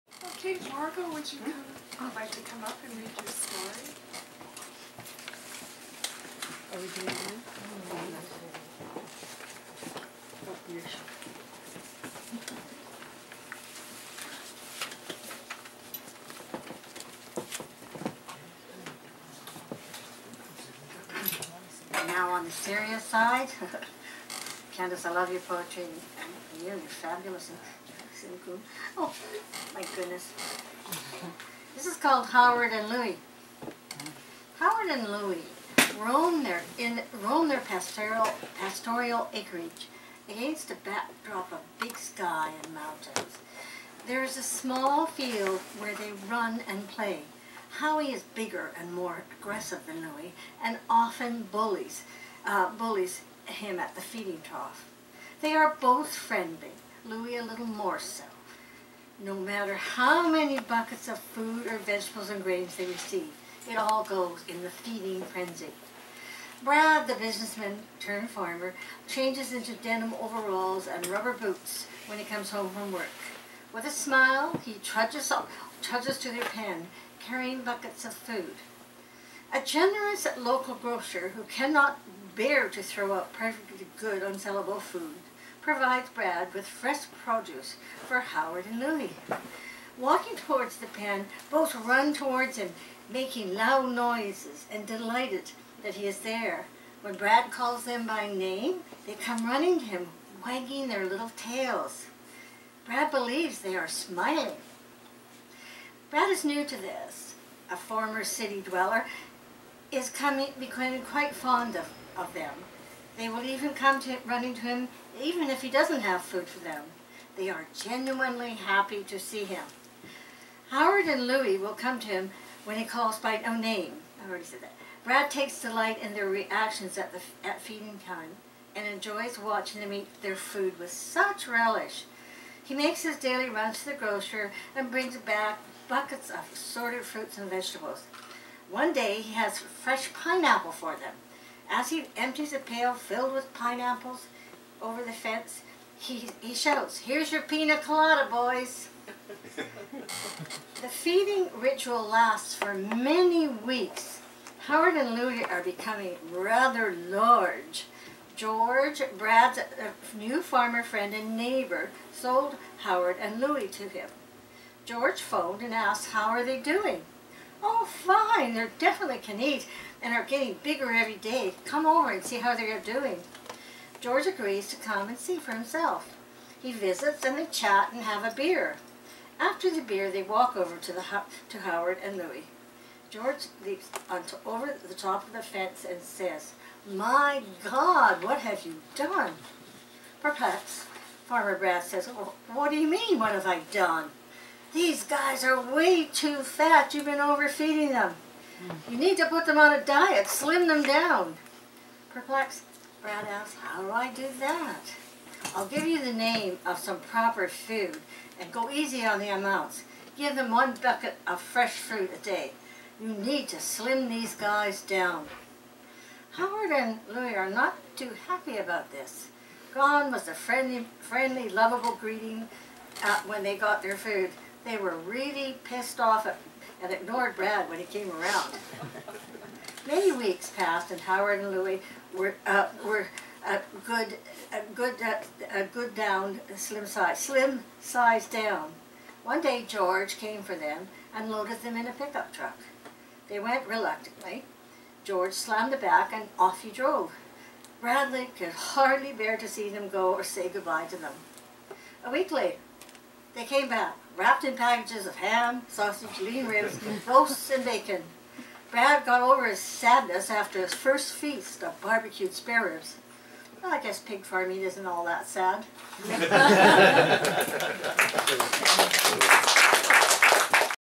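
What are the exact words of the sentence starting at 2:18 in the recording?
One day he has fresh pineapple for them.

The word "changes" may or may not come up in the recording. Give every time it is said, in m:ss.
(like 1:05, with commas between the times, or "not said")
1:09.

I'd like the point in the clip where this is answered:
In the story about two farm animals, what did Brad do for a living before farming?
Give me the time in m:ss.
1:07.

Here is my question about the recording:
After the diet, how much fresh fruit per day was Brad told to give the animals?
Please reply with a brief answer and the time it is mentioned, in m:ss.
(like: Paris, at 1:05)
one bucket, at 3:30.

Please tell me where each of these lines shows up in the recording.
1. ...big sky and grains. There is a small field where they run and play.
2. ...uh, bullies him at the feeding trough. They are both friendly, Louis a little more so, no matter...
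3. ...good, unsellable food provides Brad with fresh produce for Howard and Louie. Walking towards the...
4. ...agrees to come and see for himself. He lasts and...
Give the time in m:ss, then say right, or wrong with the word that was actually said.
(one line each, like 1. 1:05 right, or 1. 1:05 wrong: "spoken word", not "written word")
1. 0:41 wrong: "mountains", not "grains"
2. 0:52 right
3. 1:23 right
4. 2:54 wrong: "visits", not "lasts".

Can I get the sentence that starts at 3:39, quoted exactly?
Gone was the friendly, friendly lovable greeting uh, when they got their food.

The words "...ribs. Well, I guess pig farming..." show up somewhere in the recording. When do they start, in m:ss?
4:22.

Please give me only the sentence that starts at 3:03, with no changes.
George leaps onto, over the top of the fence and says, My God, what have you done?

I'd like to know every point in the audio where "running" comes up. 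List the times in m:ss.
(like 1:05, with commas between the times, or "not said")
1:39, 1:54.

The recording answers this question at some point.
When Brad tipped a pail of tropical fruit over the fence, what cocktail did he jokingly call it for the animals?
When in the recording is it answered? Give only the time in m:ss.
2:27.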